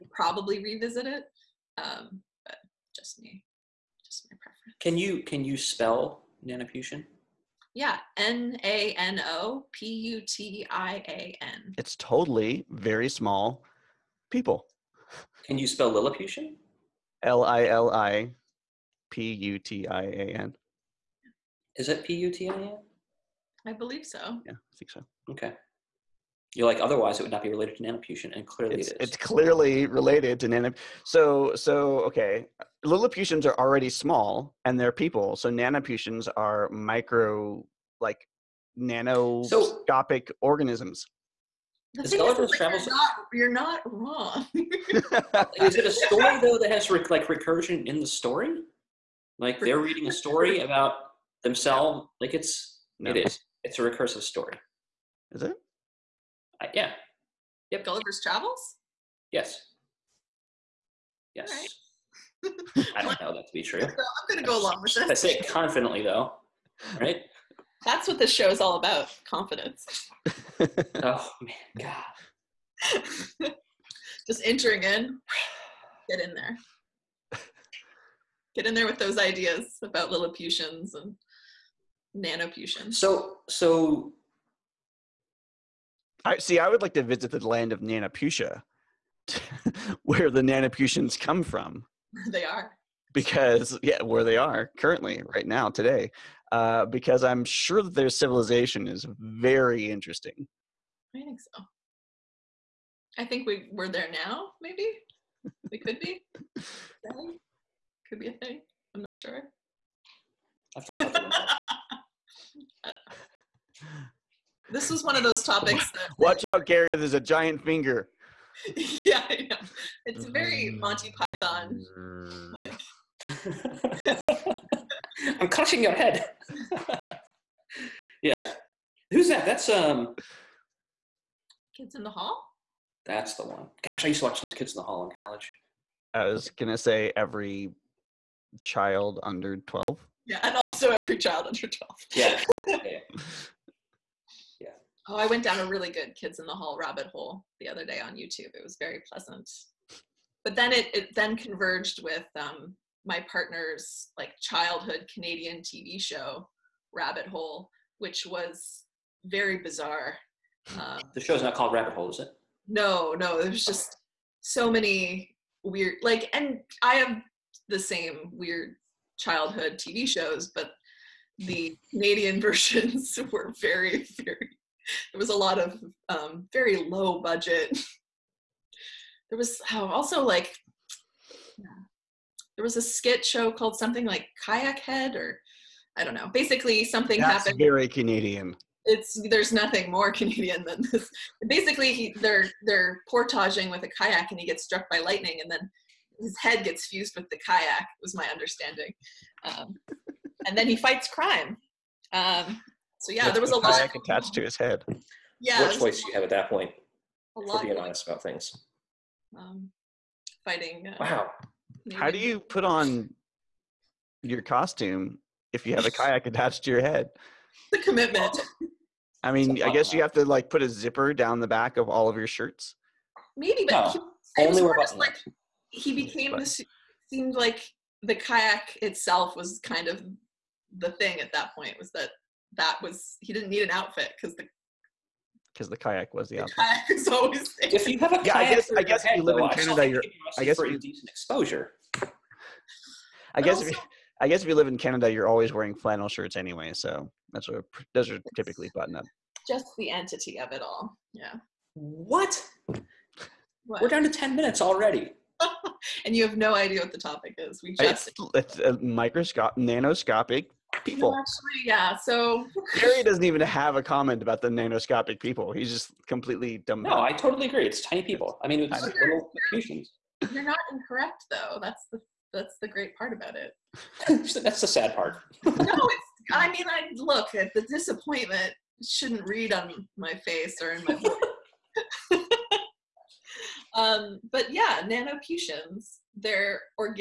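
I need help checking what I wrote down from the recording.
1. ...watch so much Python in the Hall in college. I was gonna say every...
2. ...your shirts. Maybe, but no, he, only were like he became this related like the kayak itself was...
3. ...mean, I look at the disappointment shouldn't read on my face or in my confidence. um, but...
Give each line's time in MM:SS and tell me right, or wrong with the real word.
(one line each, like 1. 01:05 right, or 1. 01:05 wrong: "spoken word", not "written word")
1. 02:14 wrong: "Kids", not "Python"
2. 03:42 wrong: "seemed", not "related"
3. 04:36 wrong: "voice", not "confidence".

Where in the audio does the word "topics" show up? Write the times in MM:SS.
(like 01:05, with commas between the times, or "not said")
01:55, 04:16.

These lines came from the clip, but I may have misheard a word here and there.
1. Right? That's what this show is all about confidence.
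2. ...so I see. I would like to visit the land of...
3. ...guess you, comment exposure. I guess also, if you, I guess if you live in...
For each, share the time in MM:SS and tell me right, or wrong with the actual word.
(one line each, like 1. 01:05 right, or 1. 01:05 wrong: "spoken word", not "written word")
1. 01:06 right
2. 01:23 right
3. 04:00 wrong: "decent", not "comment".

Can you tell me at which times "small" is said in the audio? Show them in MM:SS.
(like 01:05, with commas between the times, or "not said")
00:13, 00:33.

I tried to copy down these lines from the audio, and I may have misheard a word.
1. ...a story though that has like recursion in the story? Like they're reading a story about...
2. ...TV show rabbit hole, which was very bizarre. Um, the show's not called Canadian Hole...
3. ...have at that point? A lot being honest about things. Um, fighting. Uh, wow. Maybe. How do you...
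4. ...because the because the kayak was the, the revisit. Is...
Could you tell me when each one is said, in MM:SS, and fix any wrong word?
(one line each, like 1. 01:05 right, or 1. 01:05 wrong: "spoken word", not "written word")
1. 00:45 right
2. 02:35 wrong: "Rabbit", not "Canadian"
3. 03:26 right
4. 03:54 wrong: "outfit", not "revisit".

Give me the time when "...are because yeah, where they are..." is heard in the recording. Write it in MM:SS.
01:32.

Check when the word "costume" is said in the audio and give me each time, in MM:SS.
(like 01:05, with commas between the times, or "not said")
03:34.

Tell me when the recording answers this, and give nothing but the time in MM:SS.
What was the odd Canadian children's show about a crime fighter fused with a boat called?
03:04.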